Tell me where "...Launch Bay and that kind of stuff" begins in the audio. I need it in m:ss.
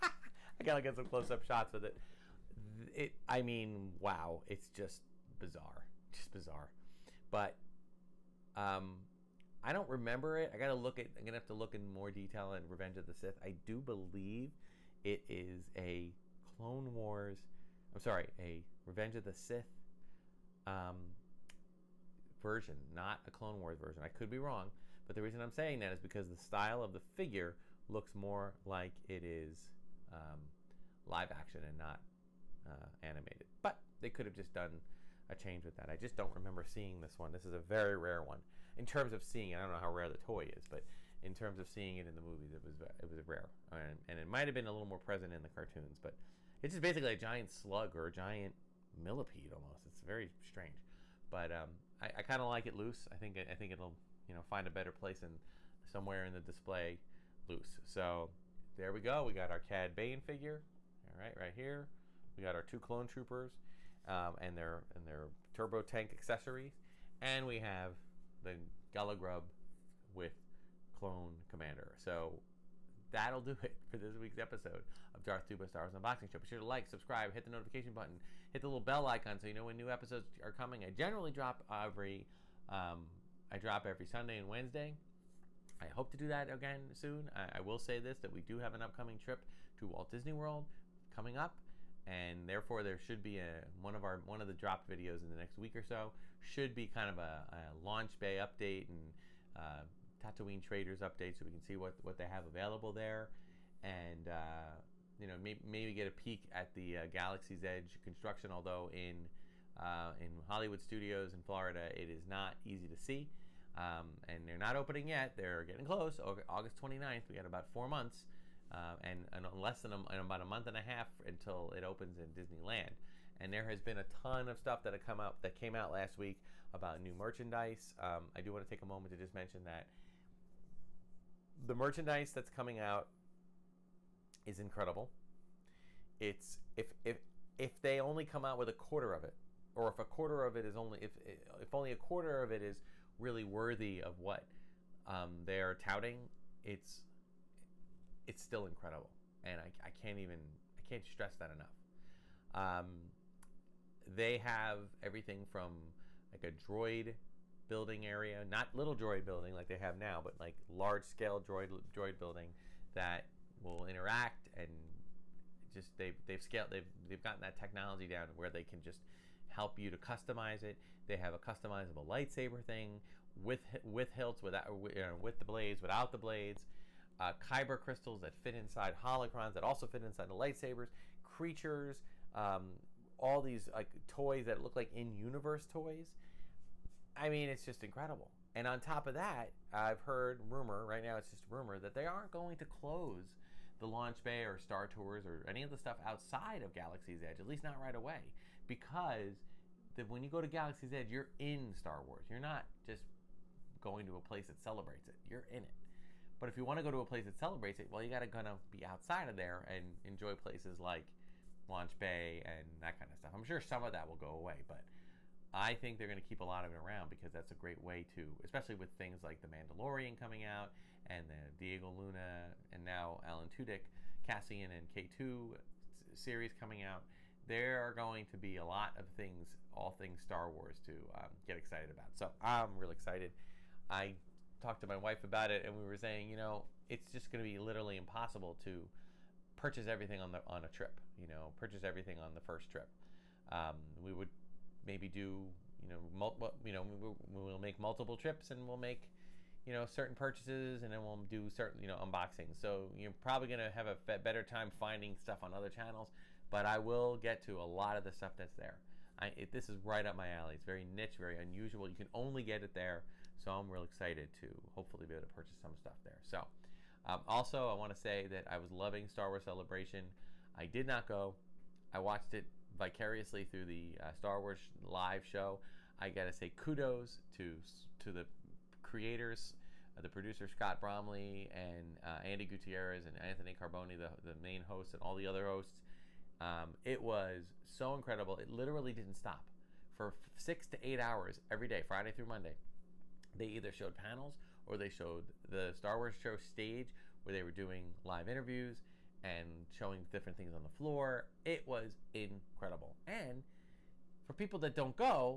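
3:31.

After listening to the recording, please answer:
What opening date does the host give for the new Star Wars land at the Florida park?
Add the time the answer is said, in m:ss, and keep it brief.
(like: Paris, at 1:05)
August 29th, at 1:56.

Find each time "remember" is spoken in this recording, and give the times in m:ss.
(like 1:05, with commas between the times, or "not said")
0:09, 0:36.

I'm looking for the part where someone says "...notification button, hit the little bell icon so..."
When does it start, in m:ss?
1:17.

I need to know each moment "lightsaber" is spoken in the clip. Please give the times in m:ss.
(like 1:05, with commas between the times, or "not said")
2:52, 3:00.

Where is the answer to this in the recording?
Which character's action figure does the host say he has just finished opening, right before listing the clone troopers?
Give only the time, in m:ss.
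0:59.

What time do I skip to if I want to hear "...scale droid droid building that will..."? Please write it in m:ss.
2:41.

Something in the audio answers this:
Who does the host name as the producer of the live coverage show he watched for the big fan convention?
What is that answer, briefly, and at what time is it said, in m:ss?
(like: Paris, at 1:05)
Scott Bromley, at 4:40.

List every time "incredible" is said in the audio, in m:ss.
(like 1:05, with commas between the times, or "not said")
2:14, 2:28, 3:07, 4:47, 5:02.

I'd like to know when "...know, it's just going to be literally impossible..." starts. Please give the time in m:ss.
3:56.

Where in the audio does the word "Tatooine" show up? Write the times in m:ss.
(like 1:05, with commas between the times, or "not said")
1:40.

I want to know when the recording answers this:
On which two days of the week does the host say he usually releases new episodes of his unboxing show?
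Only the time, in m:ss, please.
1:24.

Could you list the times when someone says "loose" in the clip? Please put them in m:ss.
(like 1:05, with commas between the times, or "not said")
0:52, 0:57.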